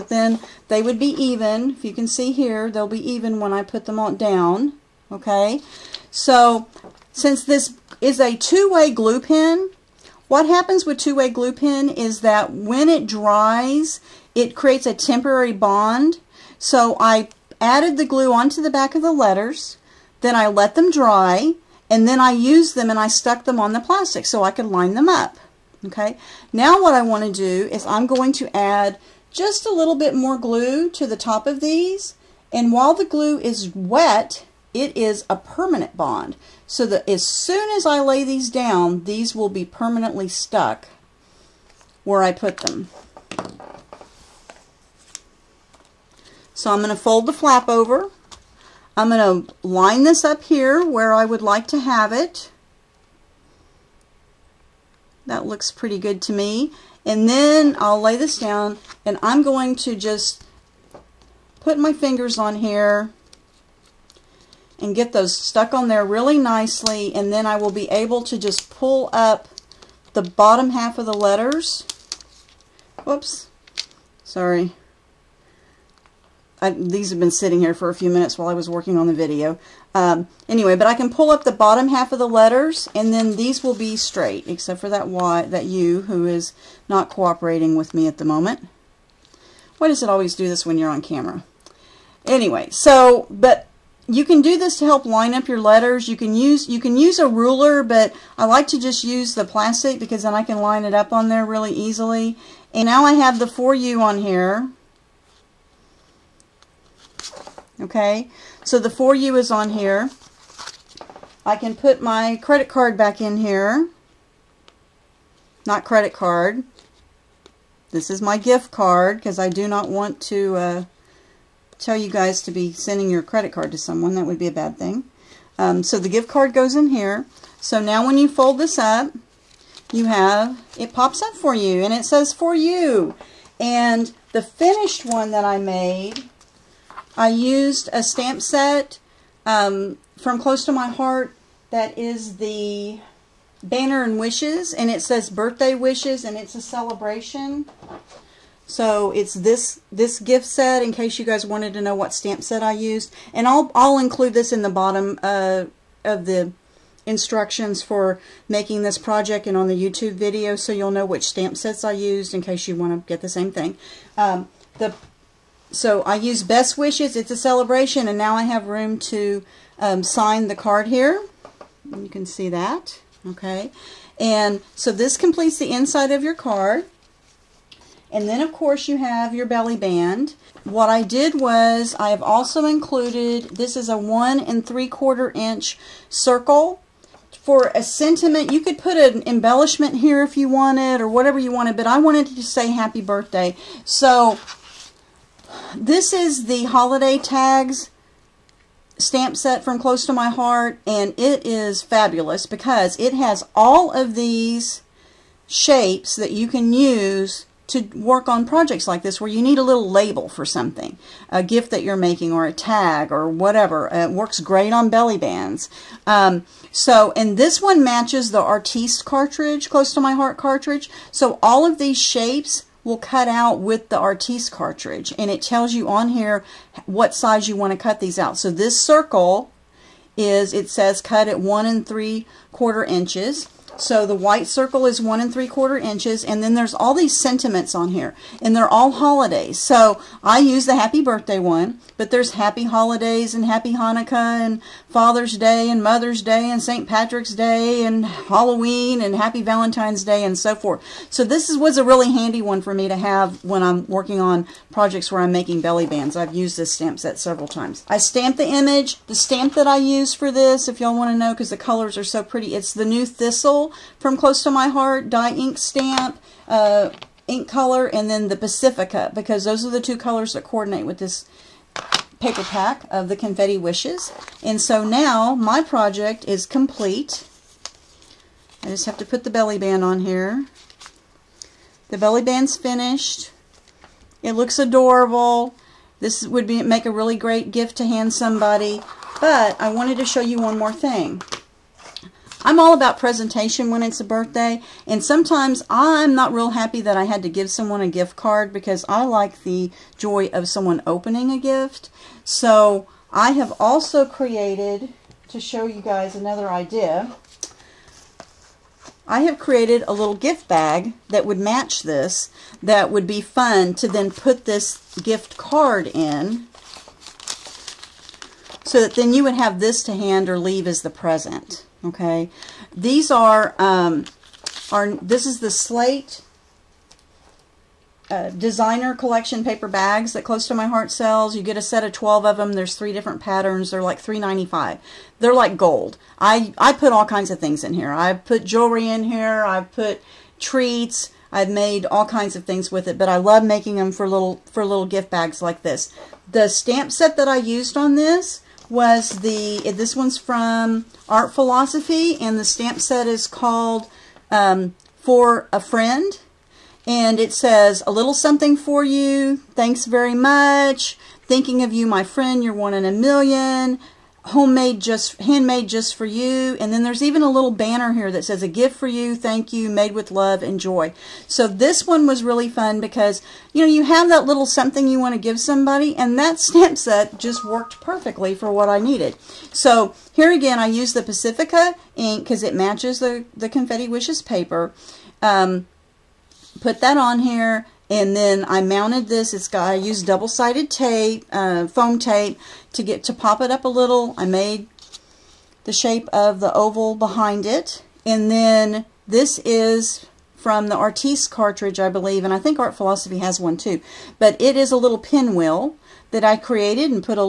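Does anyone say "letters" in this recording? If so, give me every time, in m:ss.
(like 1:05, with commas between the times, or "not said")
0:19, 1:11, 1:22, 1:35.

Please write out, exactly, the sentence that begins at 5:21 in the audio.
Okay, these are um, are this is the slate uh, designer collection paper bags that Close to My Heart sells.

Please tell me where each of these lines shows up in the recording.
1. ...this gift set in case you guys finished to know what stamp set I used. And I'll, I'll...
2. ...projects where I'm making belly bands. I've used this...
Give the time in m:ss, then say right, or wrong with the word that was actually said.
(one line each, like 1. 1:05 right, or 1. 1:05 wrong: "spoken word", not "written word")
1. 2:29 wrong: "wanted", not "finished"
2. 4:14 right.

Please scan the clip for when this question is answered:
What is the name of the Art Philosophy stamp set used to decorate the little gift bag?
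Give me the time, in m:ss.
5:54.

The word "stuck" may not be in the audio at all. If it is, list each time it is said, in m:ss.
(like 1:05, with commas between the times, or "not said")
0:23, 0:40, 1:05.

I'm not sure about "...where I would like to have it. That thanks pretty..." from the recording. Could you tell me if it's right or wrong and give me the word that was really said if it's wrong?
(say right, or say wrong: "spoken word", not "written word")
wrong: "looks", not "thanks".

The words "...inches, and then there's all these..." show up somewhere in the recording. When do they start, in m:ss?
3:55.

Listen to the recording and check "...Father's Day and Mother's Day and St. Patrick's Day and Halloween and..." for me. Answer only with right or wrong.
right.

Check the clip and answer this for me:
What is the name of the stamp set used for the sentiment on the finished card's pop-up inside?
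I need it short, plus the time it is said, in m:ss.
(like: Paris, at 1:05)
Banner and Wishes, at 2:23.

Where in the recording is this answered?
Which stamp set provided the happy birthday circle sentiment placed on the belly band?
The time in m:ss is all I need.
3:16.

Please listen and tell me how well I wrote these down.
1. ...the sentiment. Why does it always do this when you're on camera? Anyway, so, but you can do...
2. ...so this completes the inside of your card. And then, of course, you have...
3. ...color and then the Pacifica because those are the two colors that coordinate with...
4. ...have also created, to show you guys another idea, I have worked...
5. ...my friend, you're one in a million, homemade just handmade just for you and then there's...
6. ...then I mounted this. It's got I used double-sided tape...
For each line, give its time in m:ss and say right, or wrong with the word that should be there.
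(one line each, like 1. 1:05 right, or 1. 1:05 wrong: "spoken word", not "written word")
1. 1:28 wrong: "moment", not "sentiment"
2. 2:54 right
3. 4:27 right
4. 5:03 wrong: "created", not "worked"
5. 6:01 right
6. 6:28 right.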